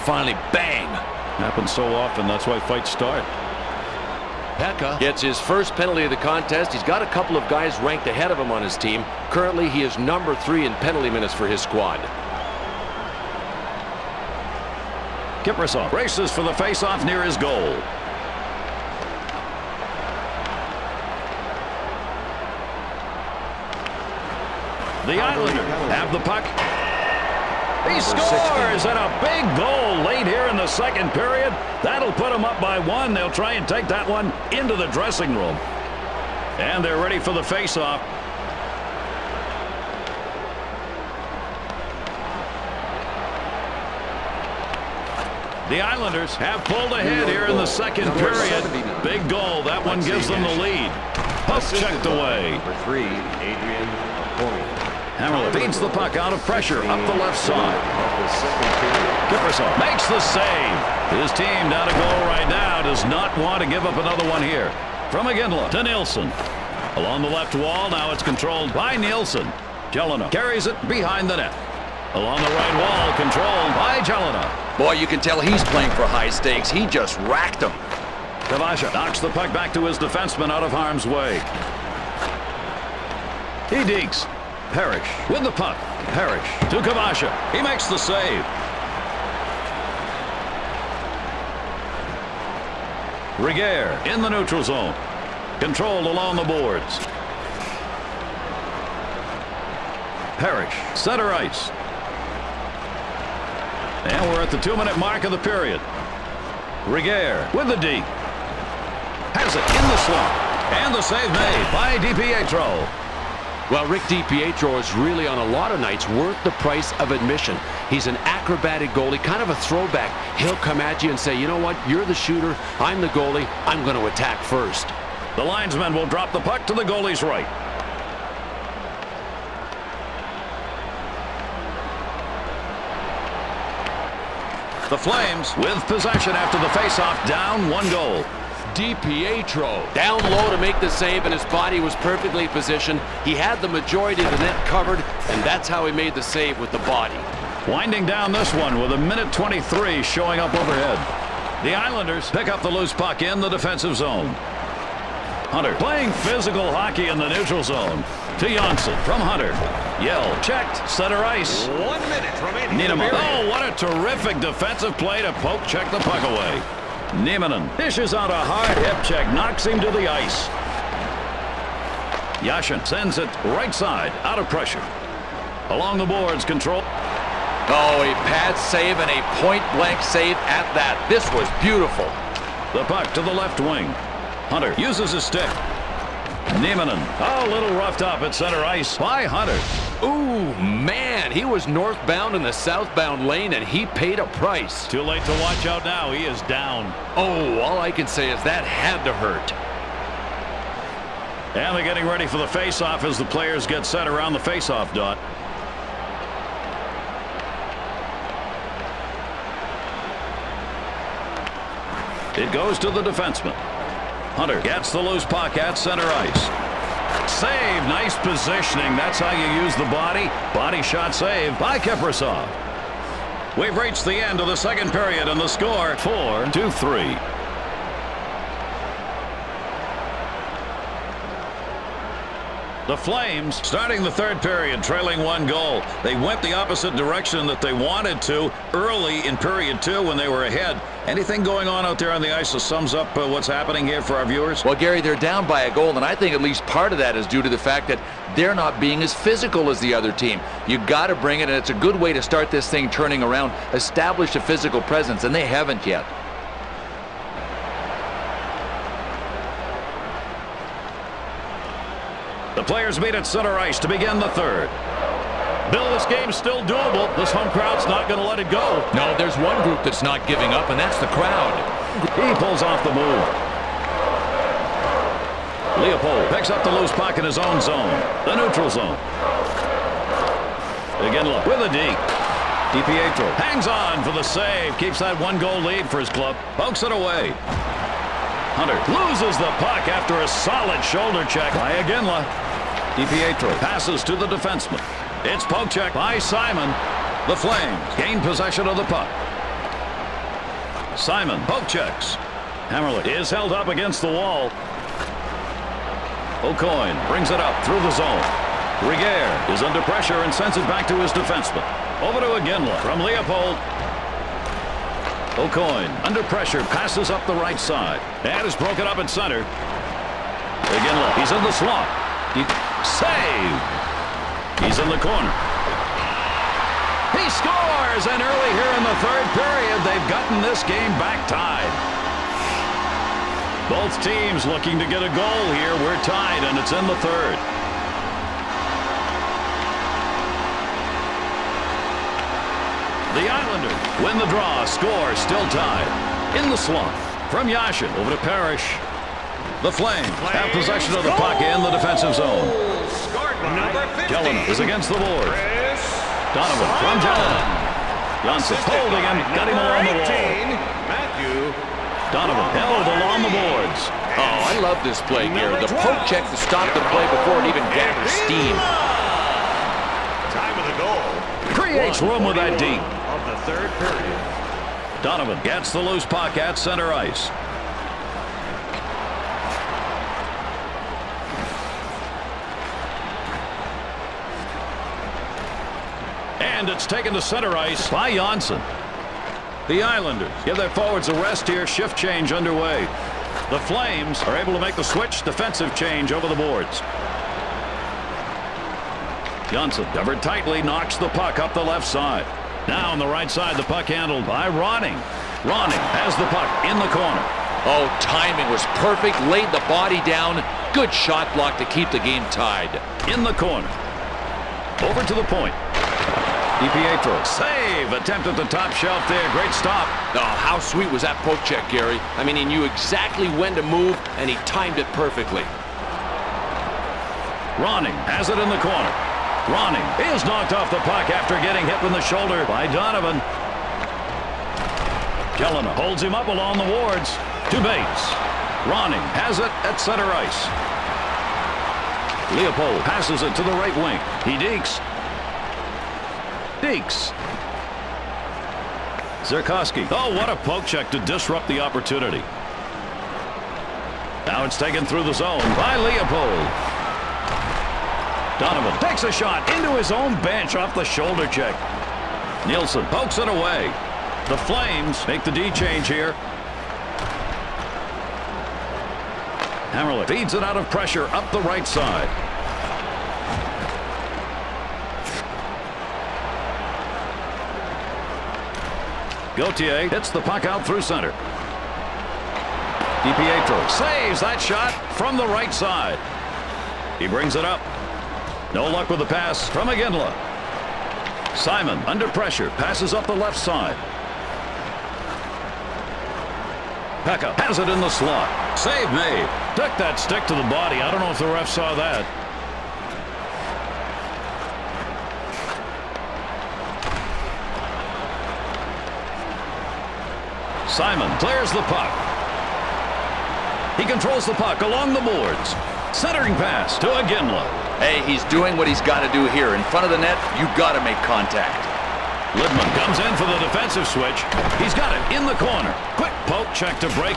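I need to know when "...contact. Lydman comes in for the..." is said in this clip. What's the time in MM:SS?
08:41.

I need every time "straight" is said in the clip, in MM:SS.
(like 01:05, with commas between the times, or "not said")
not said.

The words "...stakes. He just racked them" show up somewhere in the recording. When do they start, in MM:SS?
01:16.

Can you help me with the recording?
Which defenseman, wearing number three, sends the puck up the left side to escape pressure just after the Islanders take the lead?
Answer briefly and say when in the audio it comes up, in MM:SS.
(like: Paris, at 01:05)
Adrian Hamrlik, at 00:53.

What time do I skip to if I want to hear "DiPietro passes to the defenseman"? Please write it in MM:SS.
04:52.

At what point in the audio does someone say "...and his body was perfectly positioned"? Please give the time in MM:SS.
02:21.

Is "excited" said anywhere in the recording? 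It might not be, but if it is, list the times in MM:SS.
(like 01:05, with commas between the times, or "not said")
not said.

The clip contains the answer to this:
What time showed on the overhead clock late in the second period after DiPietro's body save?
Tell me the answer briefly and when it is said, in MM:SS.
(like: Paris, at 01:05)
1:23, at 02:28.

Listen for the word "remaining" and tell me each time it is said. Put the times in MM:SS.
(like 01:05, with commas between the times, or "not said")
02:42.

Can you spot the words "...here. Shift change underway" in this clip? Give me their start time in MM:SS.
06:31.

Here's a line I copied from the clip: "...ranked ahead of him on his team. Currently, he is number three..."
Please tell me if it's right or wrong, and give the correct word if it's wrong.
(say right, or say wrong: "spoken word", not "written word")
right.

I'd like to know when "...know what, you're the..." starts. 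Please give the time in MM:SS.
02:01.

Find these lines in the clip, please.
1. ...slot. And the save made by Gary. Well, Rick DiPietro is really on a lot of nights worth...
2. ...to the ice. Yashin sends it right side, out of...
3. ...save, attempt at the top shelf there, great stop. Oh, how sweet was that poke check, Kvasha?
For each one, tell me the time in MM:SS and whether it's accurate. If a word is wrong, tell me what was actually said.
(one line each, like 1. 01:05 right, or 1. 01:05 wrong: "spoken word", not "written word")
1. 01:50 wrong: "DiPietro", not "Gary"
2. 02:49 right
3. 06:57 wrong: "Gary", not "Kvasha".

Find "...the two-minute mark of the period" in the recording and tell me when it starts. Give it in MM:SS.
01:44.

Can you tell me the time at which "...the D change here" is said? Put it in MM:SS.
07:45.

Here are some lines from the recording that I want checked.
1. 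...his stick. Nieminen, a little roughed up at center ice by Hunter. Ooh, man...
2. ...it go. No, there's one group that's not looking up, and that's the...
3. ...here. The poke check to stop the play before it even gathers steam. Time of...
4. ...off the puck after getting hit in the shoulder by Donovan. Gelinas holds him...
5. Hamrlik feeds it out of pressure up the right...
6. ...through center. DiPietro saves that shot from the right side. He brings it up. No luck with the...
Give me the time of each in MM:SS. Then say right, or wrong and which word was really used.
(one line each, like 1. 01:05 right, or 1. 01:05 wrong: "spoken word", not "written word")
1. 03:05 right
2. 04:28 wrong: "giving", not "looking"
3. 06:05 right
4. 07:10 right
5. 07:49 right
6. 08:00 right.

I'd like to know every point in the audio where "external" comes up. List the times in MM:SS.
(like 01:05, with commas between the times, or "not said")
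not said.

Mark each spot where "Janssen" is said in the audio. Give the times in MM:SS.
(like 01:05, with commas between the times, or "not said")
02:38, 06:28, 06:39.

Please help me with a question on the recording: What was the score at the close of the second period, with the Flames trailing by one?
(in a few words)
4 to 3.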